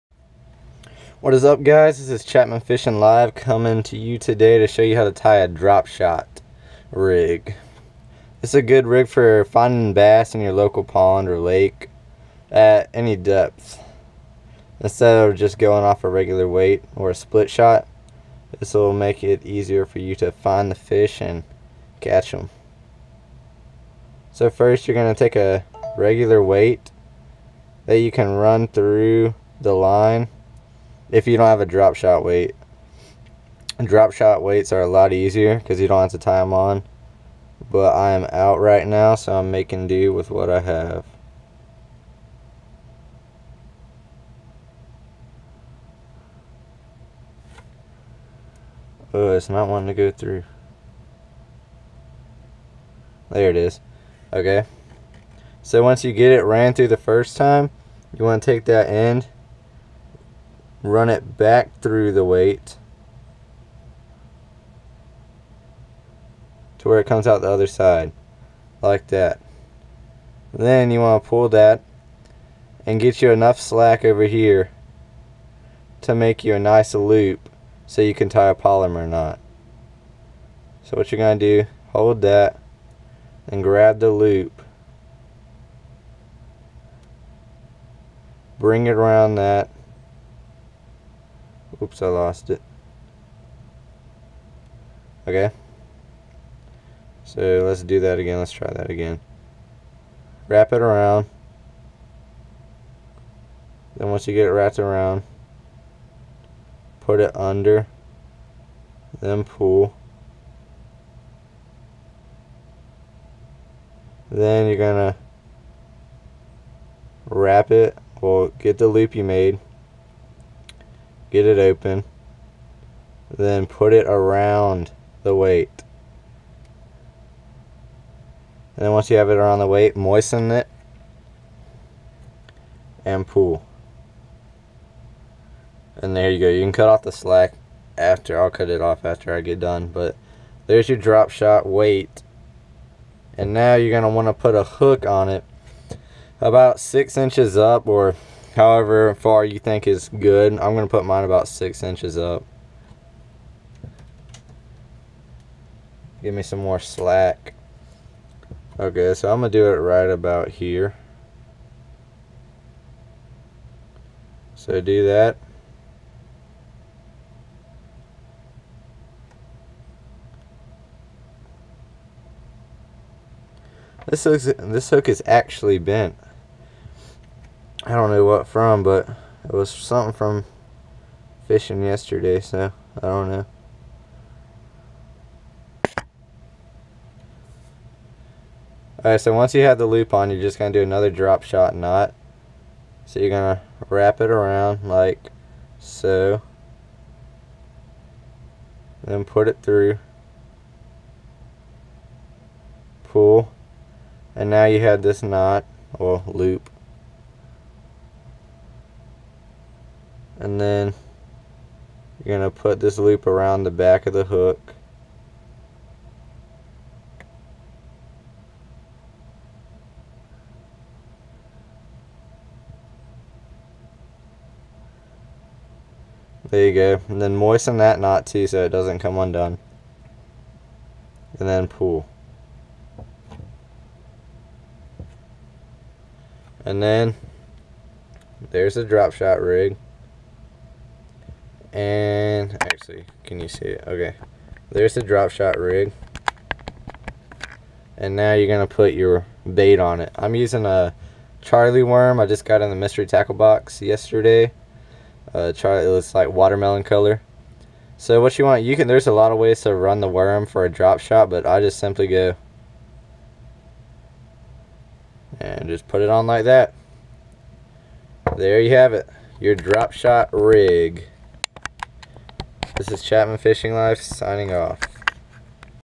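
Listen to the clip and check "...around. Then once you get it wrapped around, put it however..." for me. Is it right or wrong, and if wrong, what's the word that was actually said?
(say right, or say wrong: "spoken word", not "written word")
wrong: "under", not "however".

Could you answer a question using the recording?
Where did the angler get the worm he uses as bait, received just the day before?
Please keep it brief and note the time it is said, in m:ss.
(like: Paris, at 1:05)
Mystery tackle box, at 4:12.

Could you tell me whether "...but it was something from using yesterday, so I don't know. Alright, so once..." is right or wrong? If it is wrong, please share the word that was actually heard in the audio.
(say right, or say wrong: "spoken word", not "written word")
wrong: "fishing", not "using".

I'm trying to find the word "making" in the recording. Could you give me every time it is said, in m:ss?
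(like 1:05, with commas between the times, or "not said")
0:39.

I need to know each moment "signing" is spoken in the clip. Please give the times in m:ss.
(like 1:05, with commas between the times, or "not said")
4:34.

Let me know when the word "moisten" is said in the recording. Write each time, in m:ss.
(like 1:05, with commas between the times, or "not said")
2:09, 3:47.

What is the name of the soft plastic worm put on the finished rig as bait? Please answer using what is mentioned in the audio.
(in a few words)
Charlie worm.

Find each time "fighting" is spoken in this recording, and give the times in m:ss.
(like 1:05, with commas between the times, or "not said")
not said.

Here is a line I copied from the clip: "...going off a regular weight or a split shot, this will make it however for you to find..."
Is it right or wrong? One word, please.
wrong.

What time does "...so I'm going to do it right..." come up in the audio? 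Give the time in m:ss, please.
2:39.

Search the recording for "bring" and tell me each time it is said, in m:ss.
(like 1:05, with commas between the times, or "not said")
1:28.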